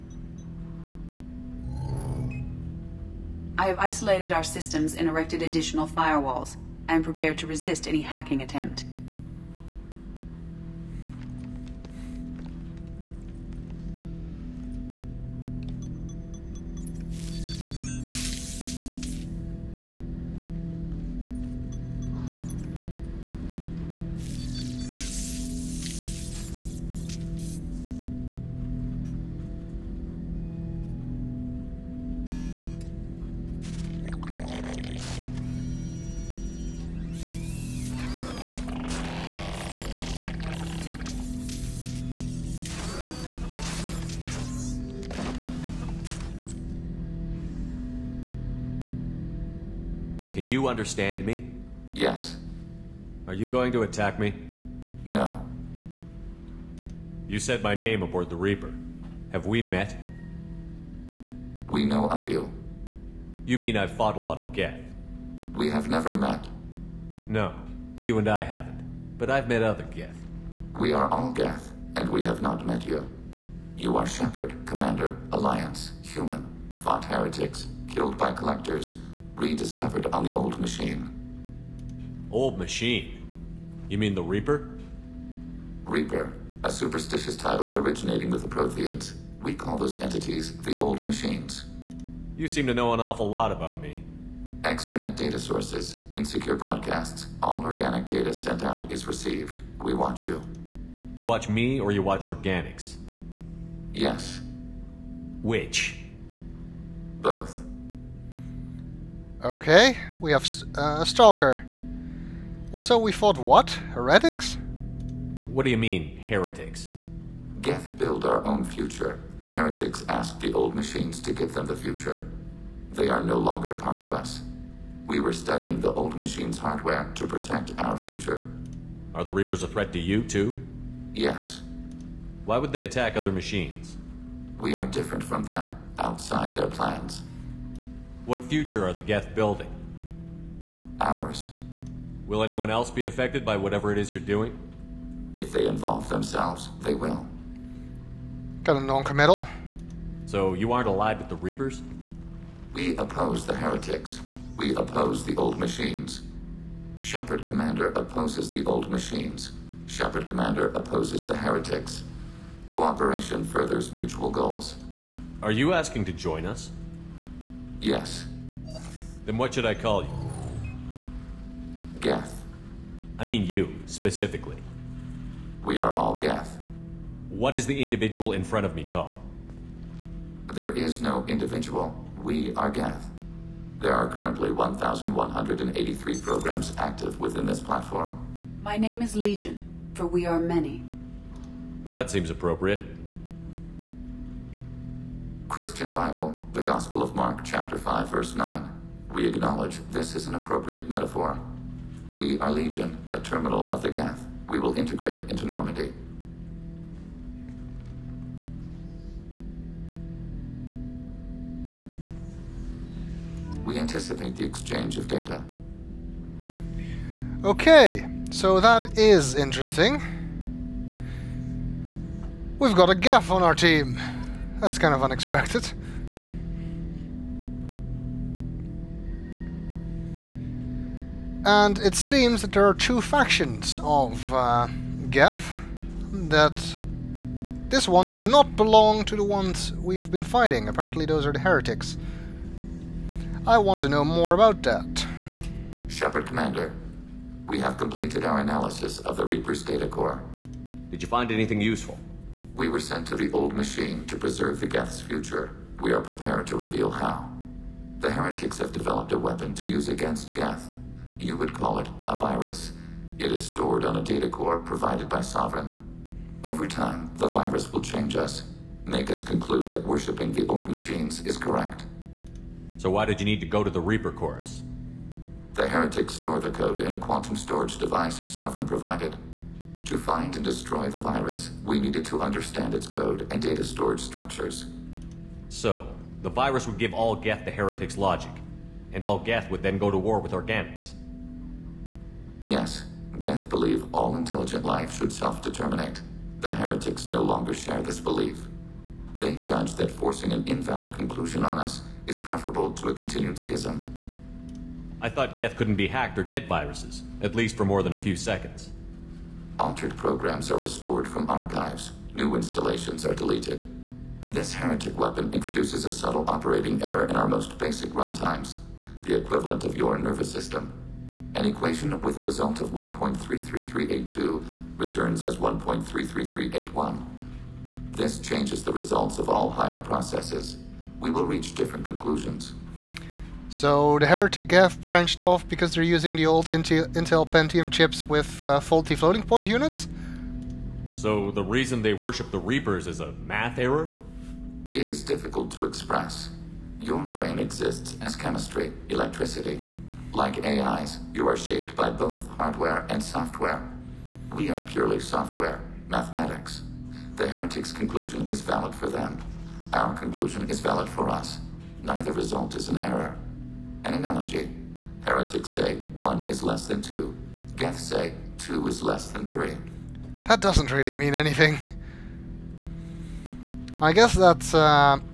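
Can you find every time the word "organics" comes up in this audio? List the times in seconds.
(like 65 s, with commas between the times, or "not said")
97 s, 102 s, 290 s.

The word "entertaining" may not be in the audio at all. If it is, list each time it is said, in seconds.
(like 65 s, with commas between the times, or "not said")
not said.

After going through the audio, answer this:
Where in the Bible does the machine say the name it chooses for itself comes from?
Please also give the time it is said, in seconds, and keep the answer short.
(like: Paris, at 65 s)
Gospel of Mark, chapter 5, verse 9, at 196 s.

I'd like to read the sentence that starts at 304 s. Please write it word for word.
I thought Geth couldn't be hacked or get viruses, at least for more than a few seconds.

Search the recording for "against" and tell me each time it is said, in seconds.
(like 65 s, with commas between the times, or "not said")
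259 s.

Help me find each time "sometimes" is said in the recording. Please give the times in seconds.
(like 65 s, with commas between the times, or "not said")
not said.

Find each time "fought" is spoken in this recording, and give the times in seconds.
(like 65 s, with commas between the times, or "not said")
63 s, 76 s, 113 s.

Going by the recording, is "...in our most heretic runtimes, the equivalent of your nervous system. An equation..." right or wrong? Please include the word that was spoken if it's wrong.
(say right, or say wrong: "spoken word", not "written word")
wrong: "basic", not "heretic".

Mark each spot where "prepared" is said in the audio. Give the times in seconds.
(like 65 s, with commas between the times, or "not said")
7 s, 256 s.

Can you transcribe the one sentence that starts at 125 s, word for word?
We were studying the old machines' hardware to protect our future.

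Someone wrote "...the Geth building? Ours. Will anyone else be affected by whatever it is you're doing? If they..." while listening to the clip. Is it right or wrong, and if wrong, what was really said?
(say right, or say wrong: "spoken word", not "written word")
right.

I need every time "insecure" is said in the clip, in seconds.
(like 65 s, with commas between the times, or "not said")
96 s.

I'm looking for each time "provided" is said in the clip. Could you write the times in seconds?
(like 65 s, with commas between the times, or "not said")
264 s, 278 s.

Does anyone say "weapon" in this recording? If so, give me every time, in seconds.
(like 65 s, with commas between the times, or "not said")
259 s, 314 s.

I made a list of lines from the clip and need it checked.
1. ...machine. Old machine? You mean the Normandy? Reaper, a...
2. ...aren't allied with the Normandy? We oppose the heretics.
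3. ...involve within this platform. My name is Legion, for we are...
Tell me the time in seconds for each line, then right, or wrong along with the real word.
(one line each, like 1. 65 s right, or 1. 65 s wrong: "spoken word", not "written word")
1. 80 s wrong: "Reaper", not "Normandy"
2. 150 s wrong: "Reapers", not "Normandy"
3. 186 s wrong: "active", not "involve".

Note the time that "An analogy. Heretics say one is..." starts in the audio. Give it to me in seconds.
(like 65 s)
363 s.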